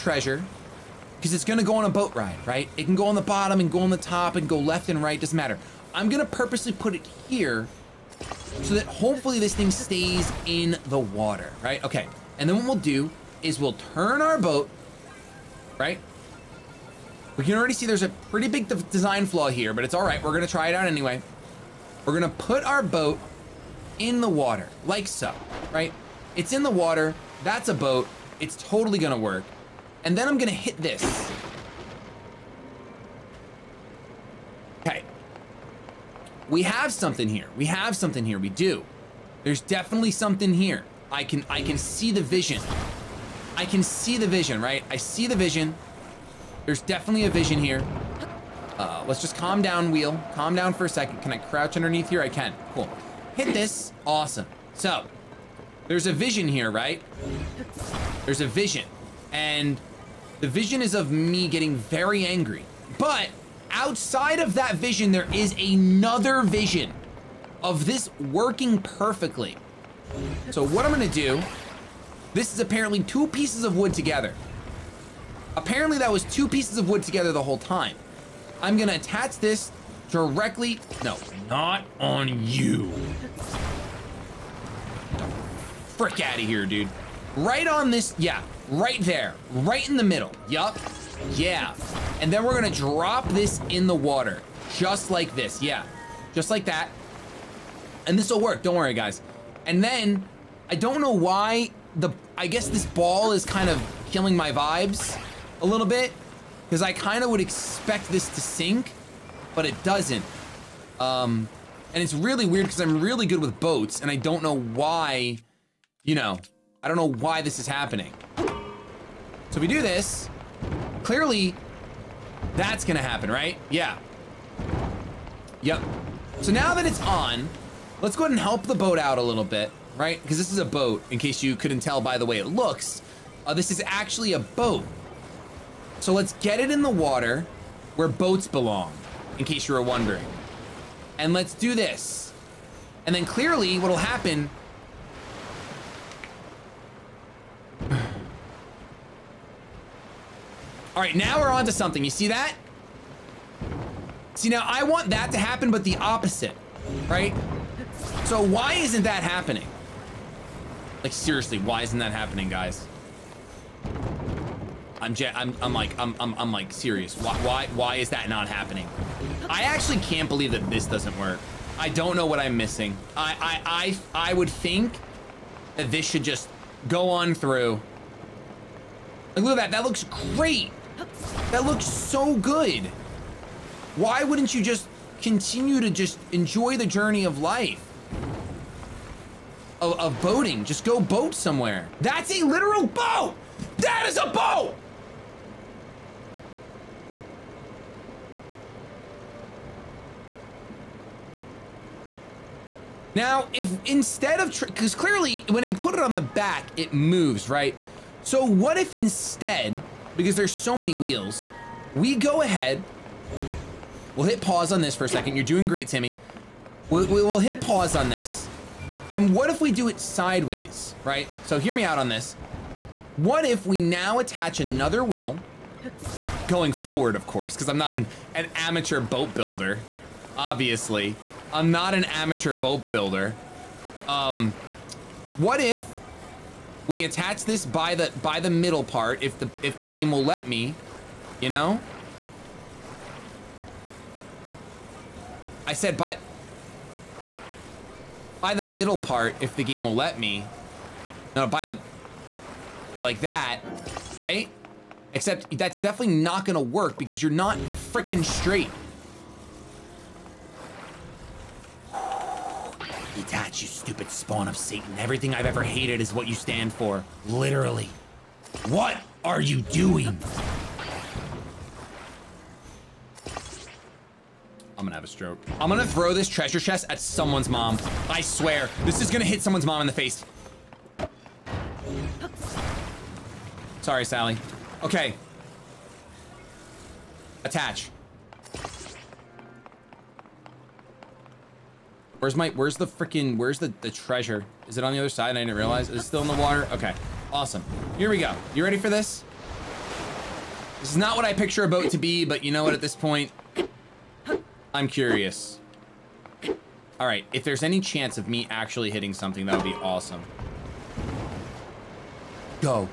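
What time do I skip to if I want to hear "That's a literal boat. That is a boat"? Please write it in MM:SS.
03:12.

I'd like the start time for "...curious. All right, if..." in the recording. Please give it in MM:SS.
05:04.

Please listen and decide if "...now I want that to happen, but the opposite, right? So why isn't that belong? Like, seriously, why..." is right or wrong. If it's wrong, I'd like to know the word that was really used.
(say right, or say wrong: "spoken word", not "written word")
wrong: "happening", not "belong".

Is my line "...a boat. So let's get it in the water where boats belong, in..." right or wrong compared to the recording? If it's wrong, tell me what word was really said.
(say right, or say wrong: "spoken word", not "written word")
right.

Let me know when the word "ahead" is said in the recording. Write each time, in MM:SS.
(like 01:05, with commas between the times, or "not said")
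02:08, 03:32.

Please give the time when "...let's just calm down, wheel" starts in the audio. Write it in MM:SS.
00:49.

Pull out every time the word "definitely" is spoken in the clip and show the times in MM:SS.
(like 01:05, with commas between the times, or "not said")
00:39, 00:46, 04:15.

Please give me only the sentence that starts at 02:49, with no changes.
I actually can't believe that this doesn't work.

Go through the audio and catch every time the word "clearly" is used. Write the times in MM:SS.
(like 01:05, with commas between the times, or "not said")
02:01, 02:23, 03:24.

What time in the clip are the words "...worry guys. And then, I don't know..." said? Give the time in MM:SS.
01:38.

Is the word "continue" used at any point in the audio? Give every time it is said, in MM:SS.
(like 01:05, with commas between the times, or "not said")
03:05.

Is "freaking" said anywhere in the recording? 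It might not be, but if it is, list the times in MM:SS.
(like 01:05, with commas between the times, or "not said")
04:17, 04:52.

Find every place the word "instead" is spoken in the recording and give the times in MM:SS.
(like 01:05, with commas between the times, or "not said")
03:23, 03:28.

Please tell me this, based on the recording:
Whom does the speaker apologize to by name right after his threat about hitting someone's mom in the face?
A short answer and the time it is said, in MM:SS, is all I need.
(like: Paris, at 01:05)
Sally, at 04:44.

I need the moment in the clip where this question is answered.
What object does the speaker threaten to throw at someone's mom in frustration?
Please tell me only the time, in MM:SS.
04:36.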